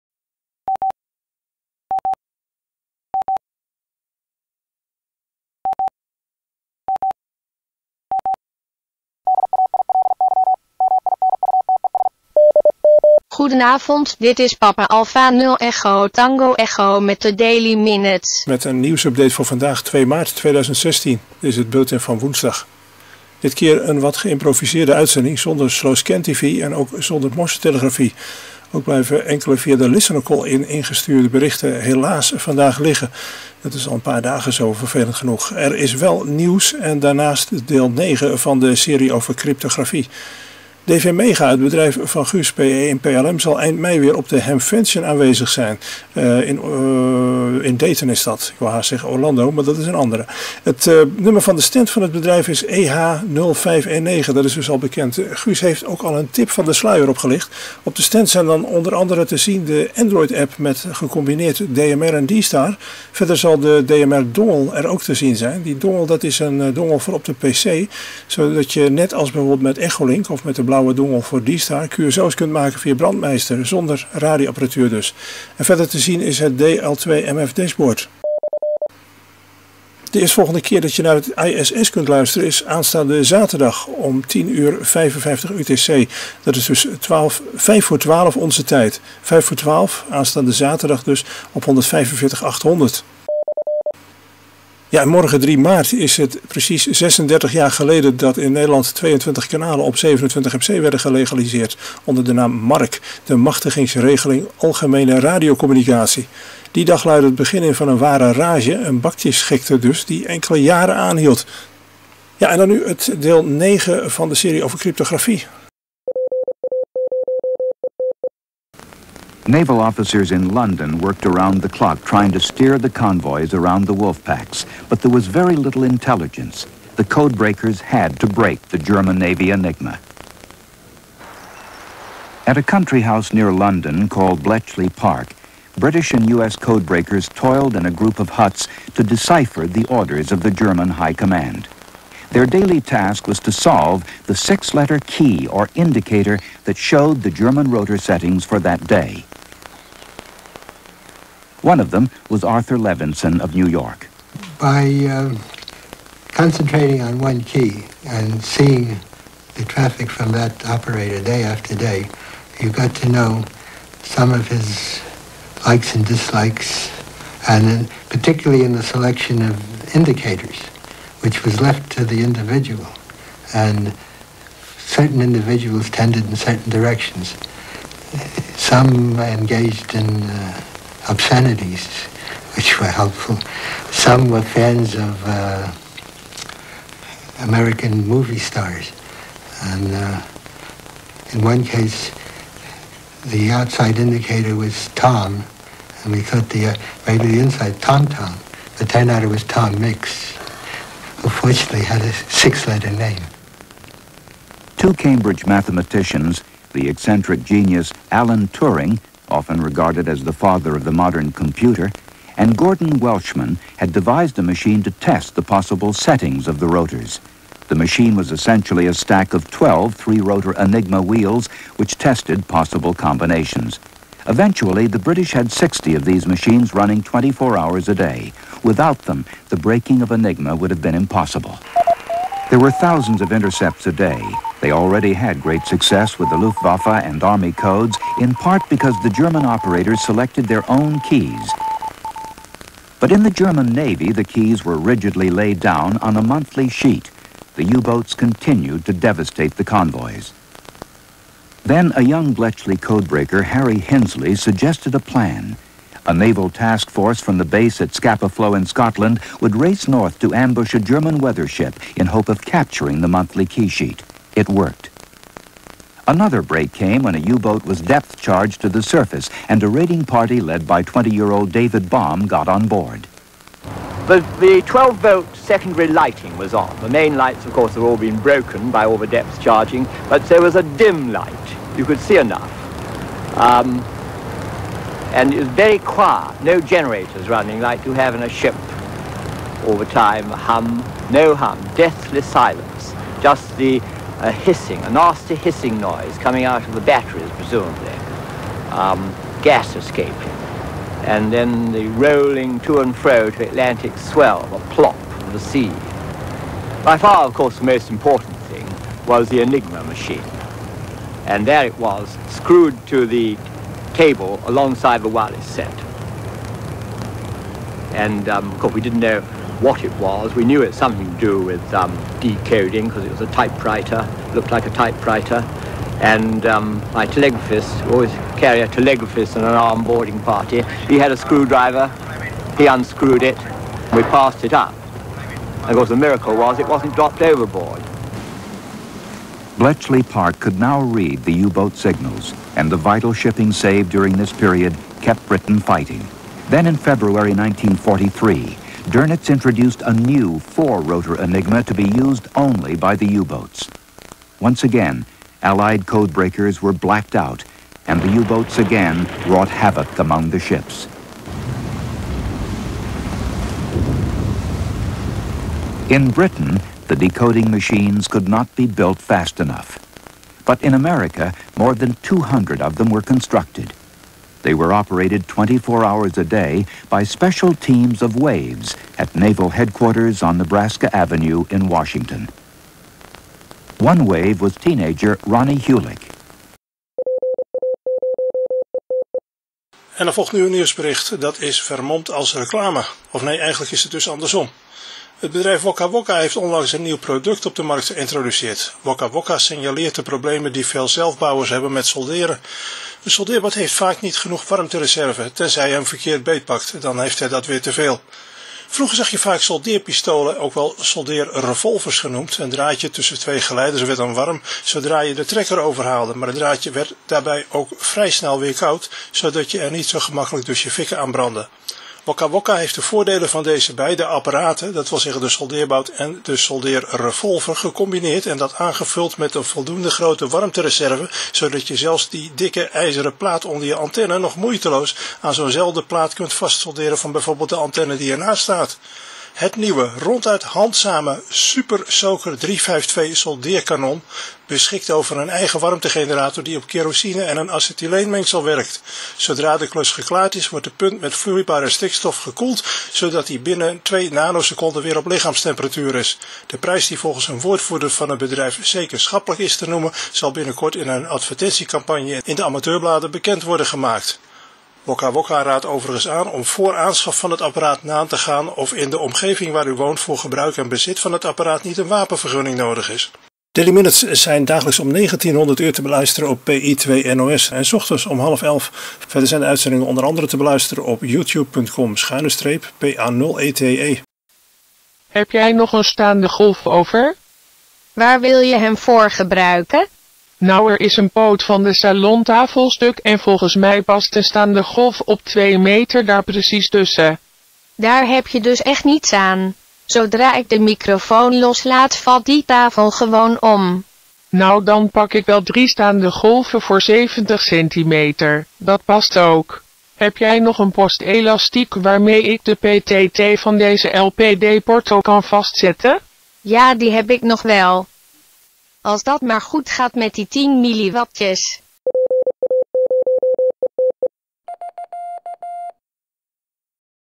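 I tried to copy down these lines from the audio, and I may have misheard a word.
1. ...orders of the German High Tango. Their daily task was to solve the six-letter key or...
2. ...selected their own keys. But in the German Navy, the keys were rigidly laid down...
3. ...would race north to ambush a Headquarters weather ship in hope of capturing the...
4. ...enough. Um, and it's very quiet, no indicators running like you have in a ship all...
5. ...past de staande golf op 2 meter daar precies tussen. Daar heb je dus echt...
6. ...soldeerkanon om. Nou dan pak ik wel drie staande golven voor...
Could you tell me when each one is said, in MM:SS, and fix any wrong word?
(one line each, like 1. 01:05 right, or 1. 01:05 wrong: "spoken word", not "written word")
1. 02:19 wrong: "Command", not "Tango"
2. 04:00 right
3. 04:19 wrong: "German", not "Headquarters"
4. 04:42 wrong: "generators", not "indicators"
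5. 08:13 right
6. 08:22 wrong: "gewoon", not "soldeerkanon".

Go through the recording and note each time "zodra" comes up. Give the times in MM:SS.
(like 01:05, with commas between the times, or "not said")
06:54, 07:29, 08:19.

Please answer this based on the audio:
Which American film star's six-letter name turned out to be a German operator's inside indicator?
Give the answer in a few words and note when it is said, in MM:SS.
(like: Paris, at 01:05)
Tom Mix, at 03:19.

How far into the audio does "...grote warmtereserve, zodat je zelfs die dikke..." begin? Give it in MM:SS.
07:09.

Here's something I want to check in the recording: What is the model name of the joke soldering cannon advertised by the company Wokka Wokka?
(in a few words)
Super Soaker 352.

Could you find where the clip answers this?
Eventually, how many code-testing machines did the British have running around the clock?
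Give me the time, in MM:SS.
03:45.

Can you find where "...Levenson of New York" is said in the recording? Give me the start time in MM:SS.
02:32.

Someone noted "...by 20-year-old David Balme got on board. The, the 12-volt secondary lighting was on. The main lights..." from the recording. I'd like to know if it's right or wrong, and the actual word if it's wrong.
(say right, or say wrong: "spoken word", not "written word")
right.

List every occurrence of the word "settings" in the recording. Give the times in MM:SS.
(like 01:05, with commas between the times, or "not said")
02:27, 03:35.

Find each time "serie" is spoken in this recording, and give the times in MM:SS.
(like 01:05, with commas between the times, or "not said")
00:38, 01:54.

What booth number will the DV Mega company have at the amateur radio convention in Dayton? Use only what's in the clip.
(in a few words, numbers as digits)
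EH0519.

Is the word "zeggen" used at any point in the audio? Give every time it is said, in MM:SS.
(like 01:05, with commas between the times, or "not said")
00:48, 07:04.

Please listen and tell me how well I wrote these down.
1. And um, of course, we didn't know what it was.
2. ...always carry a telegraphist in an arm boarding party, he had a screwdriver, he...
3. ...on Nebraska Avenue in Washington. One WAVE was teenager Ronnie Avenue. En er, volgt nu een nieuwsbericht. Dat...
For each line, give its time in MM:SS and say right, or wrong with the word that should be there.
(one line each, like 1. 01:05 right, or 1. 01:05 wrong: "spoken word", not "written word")
1. 05:17 right
2. 05:27 right
3. 06:20 wrong: "Hulick", not "Avenue".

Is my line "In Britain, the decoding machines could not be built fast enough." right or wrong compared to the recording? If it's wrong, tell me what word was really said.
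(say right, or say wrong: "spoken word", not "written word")
right.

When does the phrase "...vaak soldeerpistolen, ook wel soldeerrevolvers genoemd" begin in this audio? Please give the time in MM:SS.
06:49.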